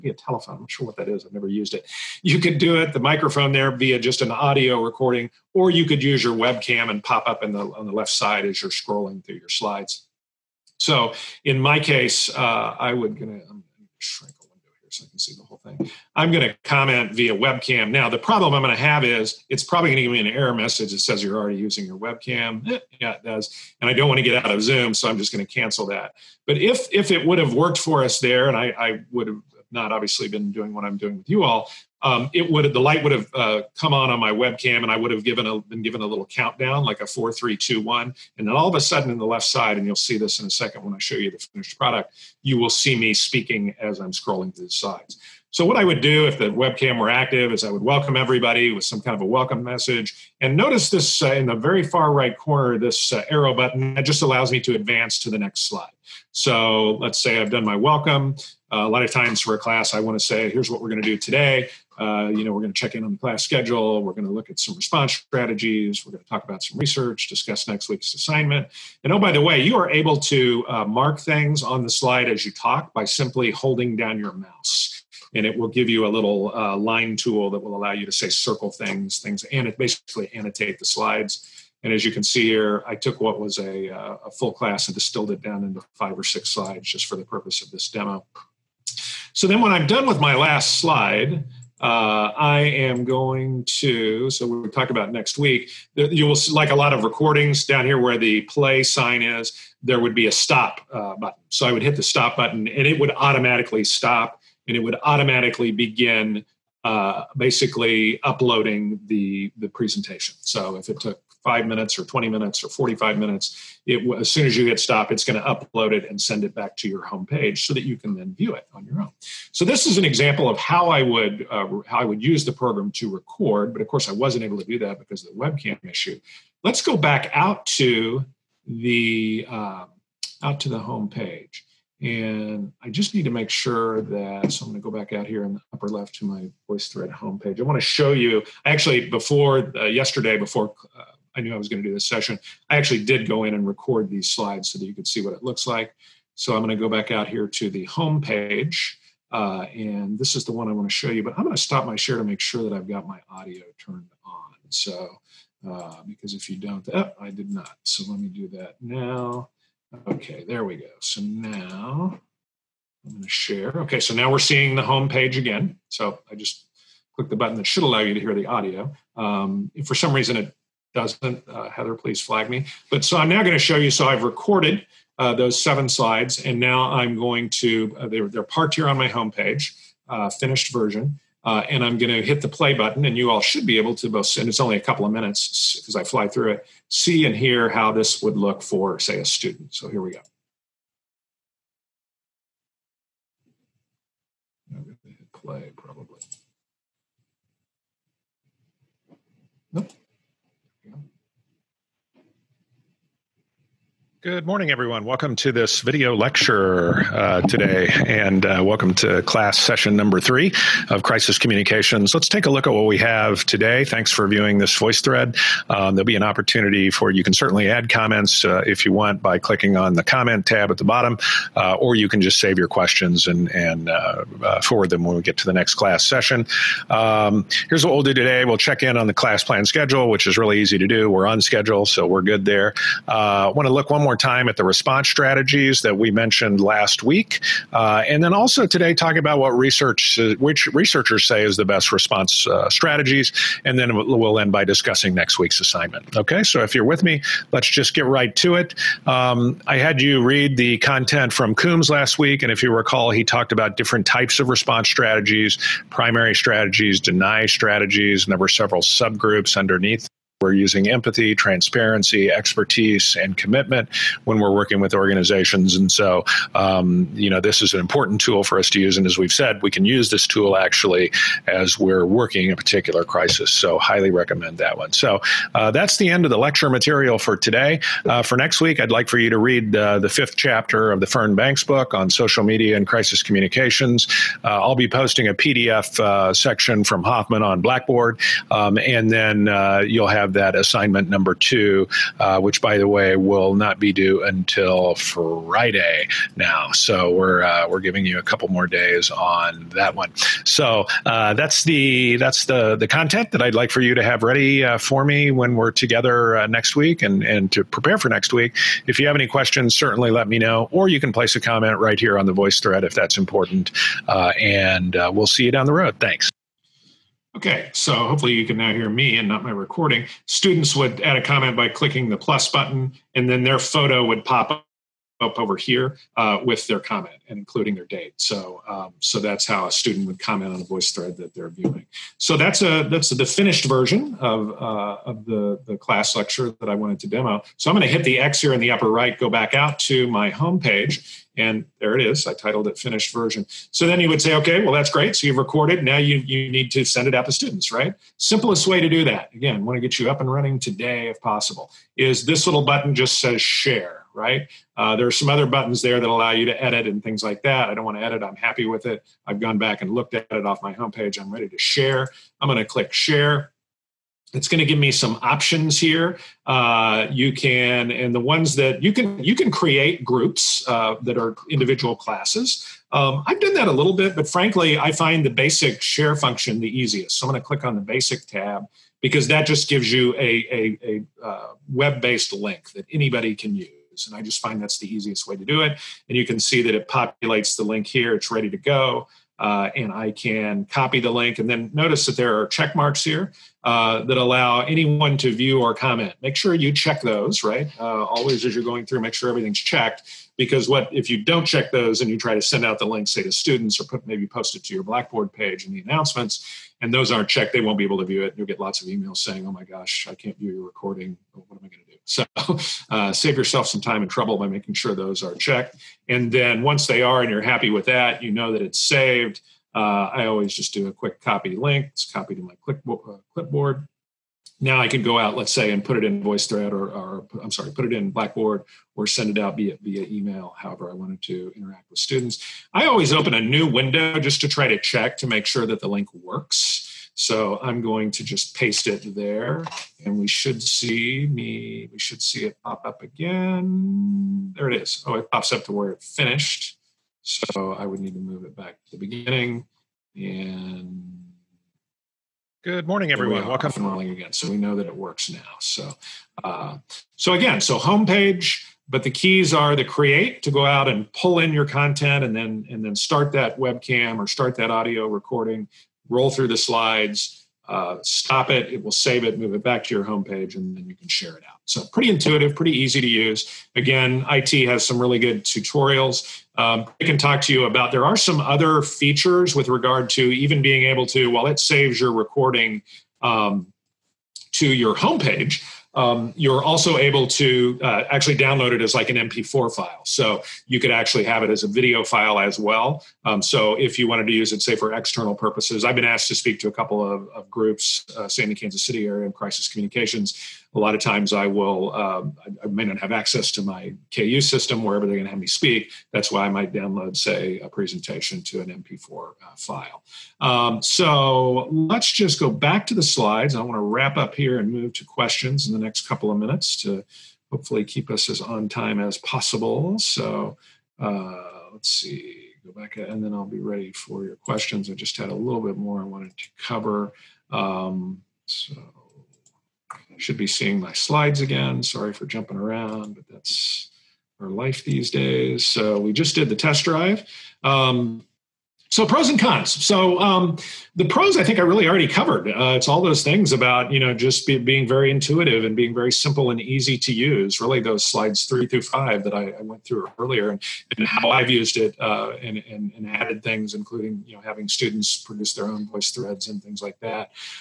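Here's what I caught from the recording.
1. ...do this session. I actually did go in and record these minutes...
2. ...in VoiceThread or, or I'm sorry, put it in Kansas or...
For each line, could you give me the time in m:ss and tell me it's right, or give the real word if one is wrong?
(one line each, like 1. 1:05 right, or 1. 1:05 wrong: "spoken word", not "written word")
1. 2:21 wrong: "slides", not "minutes"
2. 7:06 wrong: "Blackboard", not "Kansas".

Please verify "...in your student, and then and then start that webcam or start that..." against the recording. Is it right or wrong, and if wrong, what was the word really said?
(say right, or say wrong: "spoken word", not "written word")
wrong: "content", not "student".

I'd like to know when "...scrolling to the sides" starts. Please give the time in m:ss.
0:44.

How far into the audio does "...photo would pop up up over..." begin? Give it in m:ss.
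5:23.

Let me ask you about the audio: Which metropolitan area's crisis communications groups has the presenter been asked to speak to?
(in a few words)
Kansas City.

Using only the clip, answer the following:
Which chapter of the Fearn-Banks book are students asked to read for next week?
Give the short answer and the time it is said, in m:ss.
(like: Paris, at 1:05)
fifth chapter, at 4:39.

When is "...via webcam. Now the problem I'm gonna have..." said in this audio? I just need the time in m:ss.
0:17.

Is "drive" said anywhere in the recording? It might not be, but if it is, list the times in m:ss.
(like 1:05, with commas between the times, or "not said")
8:56.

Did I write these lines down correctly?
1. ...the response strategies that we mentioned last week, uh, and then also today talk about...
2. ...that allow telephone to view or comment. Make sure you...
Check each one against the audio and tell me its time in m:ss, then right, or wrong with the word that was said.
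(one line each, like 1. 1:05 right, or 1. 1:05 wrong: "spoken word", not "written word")
1. 3:54 right
2. 6:34 wrong: "anyone", not "telephone".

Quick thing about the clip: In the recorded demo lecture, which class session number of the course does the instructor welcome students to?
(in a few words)
3.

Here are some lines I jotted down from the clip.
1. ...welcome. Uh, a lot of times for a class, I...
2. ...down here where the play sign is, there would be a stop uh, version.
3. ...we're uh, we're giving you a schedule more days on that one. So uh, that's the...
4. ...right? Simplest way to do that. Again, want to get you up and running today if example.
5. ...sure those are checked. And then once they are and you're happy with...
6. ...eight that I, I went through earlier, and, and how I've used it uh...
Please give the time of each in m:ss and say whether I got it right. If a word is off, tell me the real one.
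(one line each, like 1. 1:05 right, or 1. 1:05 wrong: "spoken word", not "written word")
1. 0:57 right
2. 1:37 wrong: "button", not "version"
3. 4:57 wrong: "couple", not "schedule"
4. 5:47 wrong: "possible", not "example"
5. 6:54 right
6. 9:08 wrong: "five", not "eight".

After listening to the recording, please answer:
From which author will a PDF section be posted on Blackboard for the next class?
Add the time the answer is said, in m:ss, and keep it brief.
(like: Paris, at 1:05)
Hoffman, at 4:47.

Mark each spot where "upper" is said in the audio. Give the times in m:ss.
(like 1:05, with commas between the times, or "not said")
2:15, 5:38.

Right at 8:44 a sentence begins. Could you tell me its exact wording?
I just had a little bit more I wanted to cover.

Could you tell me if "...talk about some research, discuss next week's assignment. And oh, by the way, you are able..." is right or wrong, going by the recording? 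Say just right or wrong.
right.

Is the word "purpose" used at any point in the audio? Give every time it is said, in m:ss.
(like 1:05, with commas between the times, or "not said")
1:27, 8:15.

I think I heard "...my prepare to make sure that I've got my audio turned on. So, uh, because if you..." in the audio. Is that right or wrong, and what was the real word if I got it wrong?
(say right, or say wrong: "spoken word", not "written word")
wrong: "share", not "prepare".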